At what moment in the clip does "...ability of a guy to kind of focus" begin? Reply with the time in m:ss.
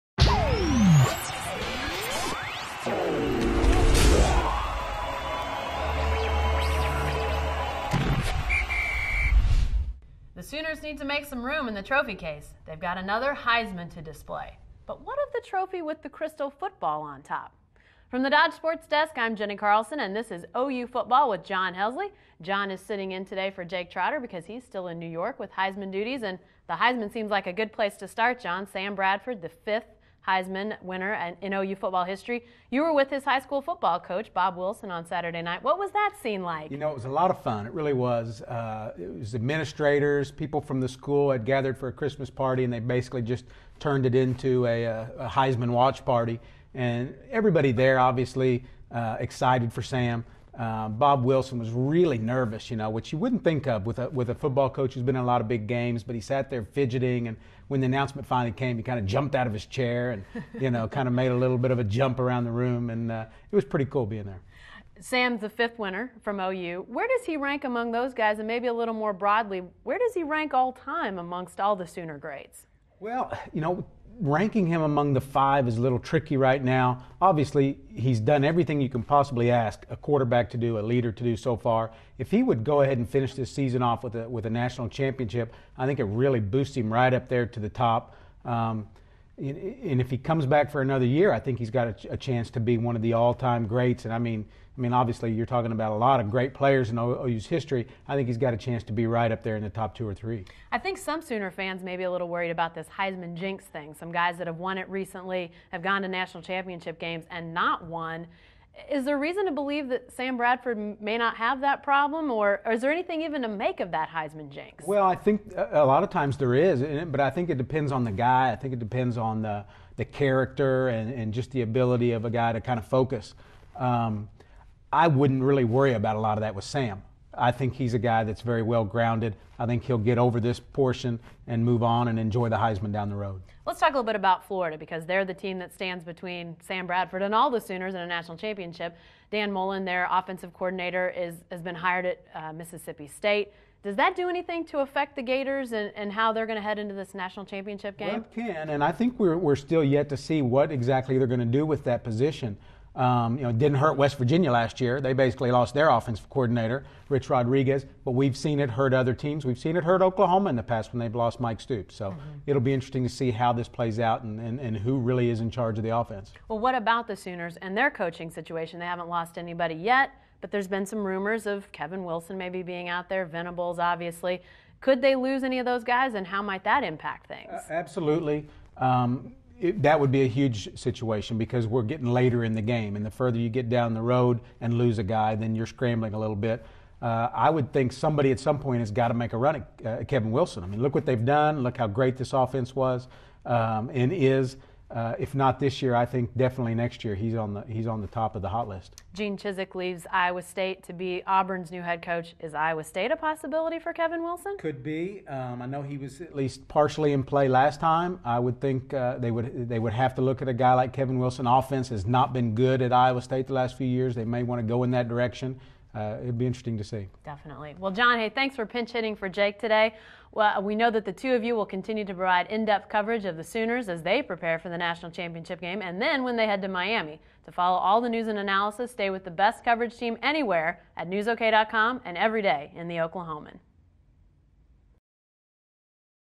2:01.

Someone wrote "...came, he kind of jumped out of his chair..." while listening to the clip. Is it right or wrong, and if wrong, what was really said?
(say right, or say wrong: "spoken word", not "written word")
right.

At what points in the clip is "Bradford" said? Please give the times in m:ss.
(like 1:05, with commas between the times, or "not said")
0:28, 1:50, 2:16.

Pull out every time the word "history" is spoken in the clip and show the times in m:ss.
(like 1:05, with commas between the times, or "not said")
0:32, 1:37.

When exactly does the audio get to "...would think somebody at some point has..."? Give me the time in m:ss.
3:07.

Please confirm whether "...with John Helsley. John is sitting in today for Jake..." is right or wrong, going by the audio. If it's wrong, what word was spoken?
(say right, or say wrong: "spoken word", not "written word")
right.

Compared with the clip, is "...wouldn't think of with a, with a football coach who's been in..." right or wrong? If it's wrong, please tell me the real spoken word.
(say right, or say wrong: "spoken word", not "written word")
right.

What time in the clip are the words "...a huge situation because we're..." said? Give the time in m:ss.
3:00.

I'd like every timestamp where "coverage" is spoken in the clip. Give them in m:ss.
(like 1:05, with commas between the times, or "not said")
3:42, 3:49.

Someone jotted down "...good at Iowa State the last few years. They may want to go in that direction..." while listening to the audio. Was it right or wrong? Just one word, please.
right.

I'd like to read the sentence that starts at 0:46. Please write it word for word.
And everybody there, obviously, uh, excited for Sam.